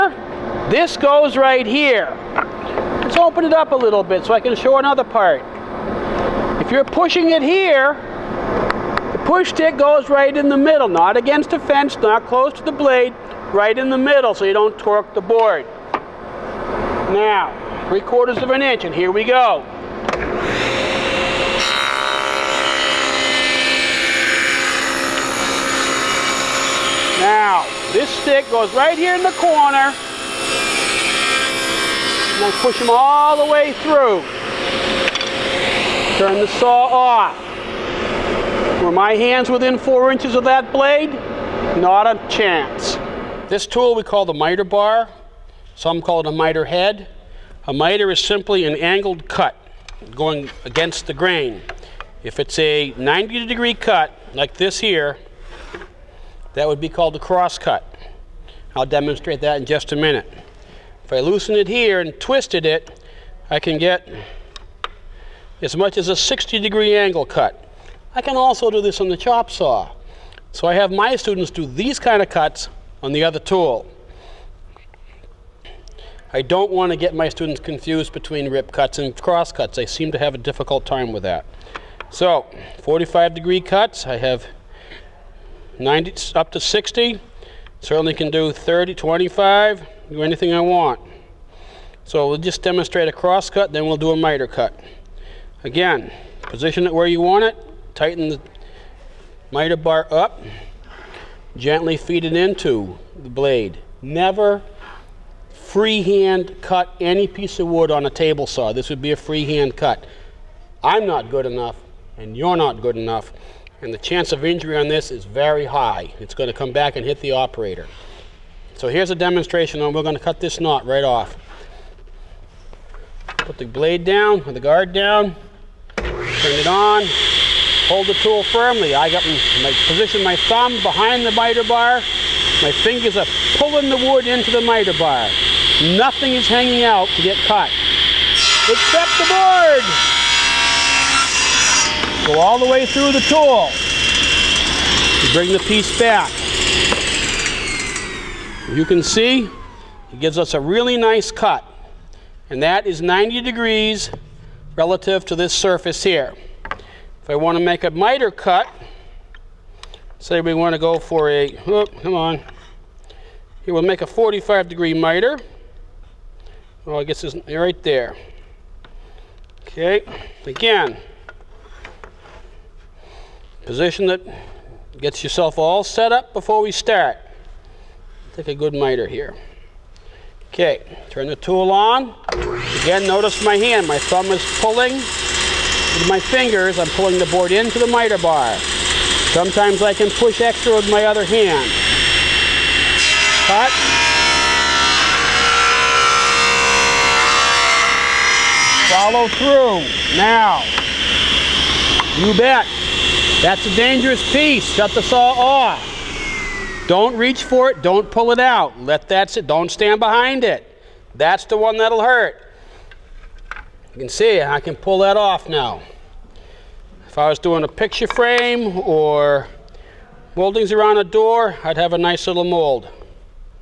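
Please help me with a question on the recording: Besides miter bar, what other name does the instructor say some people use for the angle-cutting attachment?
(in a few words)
Miter head.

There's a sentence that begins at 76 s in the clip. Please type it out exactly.
I don't want to get my students confused between rip cuts and cross cuts.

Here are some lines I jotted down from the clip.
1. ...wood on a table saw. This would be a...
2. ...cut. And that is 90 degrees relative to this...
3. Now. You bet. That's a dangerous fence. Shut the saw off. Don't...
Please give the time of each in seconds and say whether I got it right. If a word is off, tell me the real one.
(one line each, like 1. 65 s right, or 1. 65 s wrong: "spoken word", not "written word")
1. 107 s right
2. 151 s right
3. 200 s wrong: "piece", not "fence".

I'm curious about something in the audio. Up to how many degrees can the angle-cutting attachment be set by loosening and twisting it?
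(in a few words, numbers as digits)
60 degrees.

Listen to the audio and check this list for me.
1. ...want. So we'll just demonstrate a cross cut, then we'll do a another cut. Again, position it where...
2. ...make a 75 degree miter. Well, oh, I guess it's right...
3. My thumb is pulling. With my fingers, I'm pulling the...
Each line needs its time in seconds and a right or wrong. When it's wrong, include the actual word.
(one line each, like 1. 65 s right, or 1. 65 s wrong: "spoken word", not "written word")
1. 90 s wrong: "miter", not "another"
2. 163 s wrong: "45", not "75"
3. 183 s right.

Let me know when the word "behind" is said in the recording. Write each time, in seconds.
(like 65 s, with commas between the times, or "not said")
130 s, 210 s.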